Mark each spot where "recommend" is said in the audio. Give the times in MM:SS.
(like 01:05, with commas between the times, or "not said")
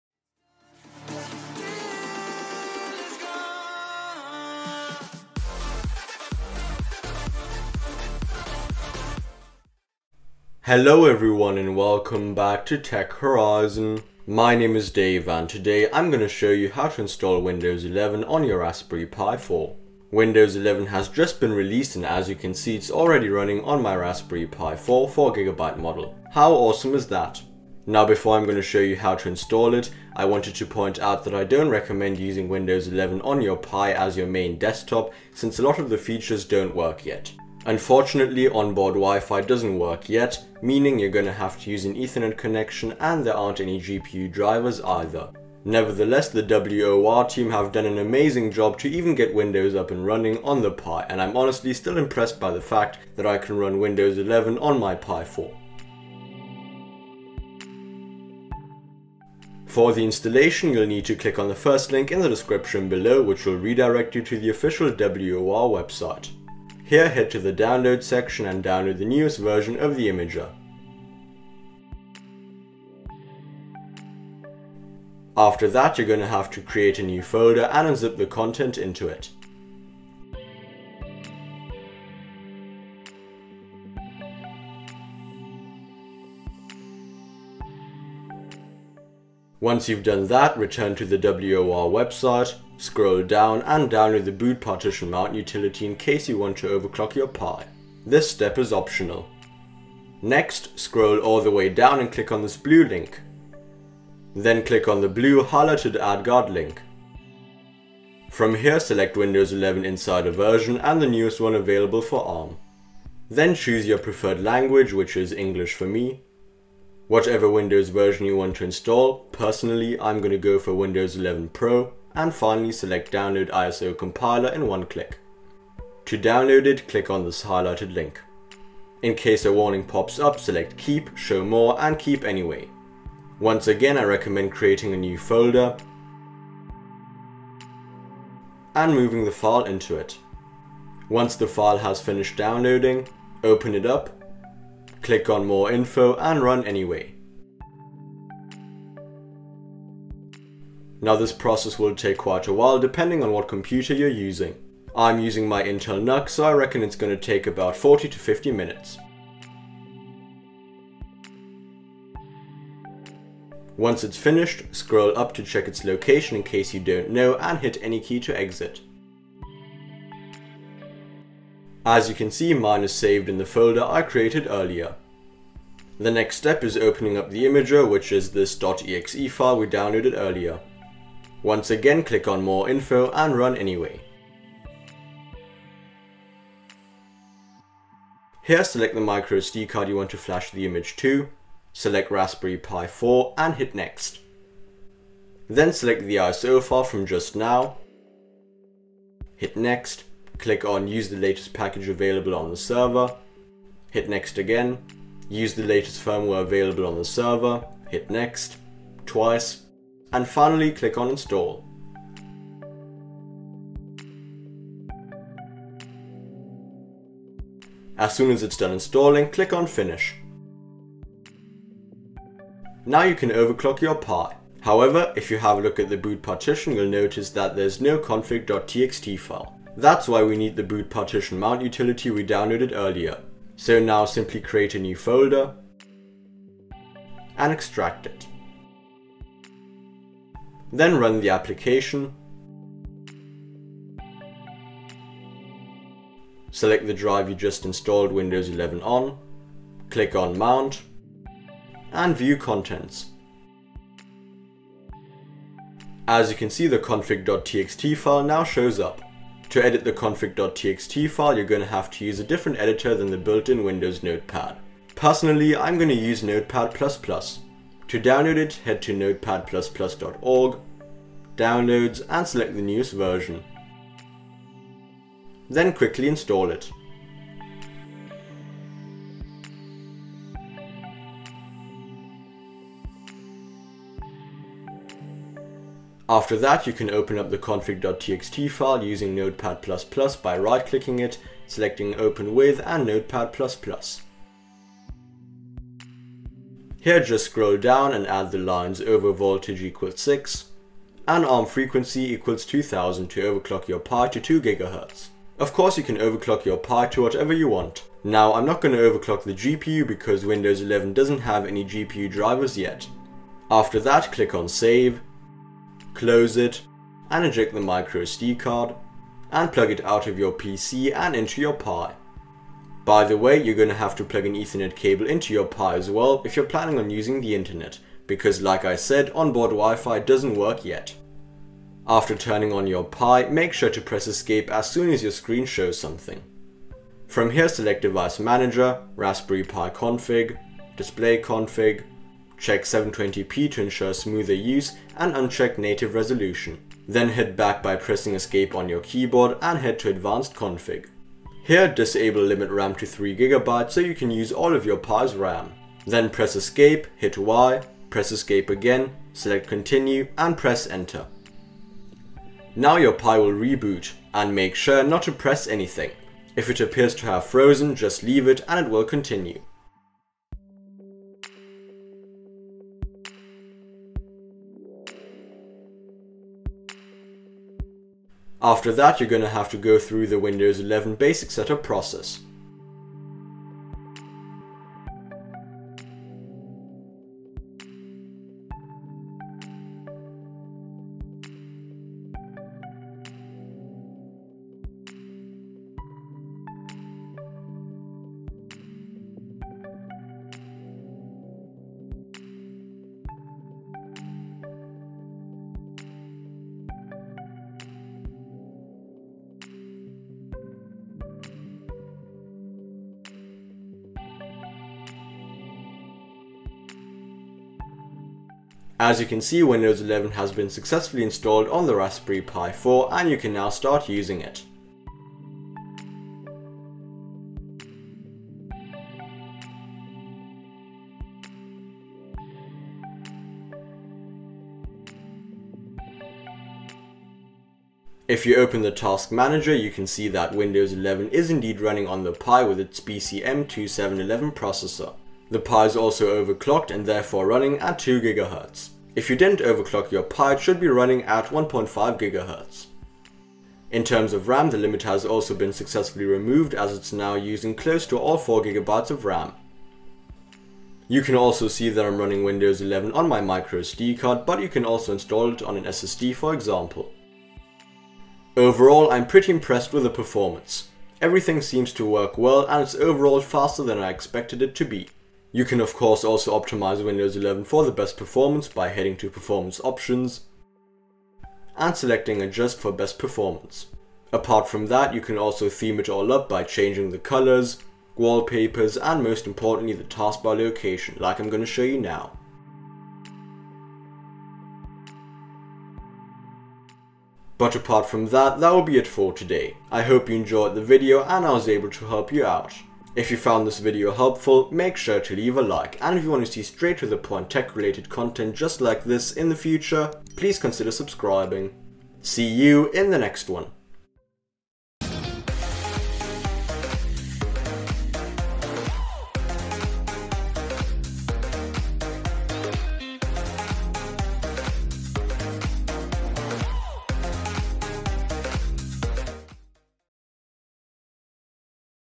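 00:31, 02:14.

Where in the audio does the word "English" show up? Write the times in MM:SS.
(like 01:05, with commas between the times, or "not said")
01:55.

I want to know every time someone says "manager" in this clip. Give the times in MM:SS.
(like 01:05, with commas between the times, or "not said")
05:38, 07:19.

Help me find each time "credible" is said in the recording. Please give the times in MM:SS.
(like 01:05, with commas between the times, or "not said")
not said.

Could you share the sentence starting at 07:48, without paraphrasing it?
Overall, I'm pretty impressed with the performance.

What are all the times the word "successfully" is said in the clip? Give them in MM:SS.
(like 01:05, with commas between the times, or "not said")
07:00, 07:35.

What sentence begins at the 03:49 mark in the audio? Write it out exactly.
That's why we need the boot partition mount utility we downloaded earlier.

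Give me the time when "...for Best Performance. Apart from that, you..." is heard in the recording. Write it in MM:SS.
08:02.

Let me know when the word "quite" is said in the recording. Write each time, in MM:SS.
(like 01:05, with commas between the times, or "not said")
02:32.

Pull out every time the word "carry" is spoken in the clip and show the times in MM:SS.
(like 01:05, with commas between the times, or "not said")
not said.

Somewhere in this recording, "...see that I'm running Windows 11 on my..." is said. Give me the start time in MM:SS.
07:41.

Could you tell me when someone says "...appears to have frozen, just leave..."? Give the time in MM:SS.
06:06.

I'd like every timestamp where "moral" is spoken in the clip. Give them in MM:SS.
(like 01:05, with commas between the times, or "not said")
not said.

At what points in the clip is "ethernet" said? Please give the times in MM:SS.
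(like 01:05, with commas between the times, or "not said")
00:41, 05:24.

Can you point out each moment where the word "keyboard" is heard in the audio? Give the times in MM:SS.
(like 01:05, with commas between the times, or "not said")
05:48.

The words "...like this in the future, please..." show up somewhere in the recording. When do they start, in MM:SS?
08:28.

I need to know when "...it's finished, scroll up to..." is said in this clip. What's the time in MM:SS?
02:44.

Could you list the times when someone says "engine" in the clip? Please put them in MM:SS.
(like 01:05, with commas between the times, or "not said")
not said.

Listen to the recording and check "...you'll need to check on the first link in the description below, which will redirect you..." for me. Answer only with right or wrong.
wrong.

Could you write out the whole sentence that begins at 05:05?
Of course you can overclock your Pi to whatever you want.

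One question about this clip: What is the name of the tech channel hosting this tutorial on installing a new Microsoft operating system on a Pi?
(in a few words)
Tech Horizon.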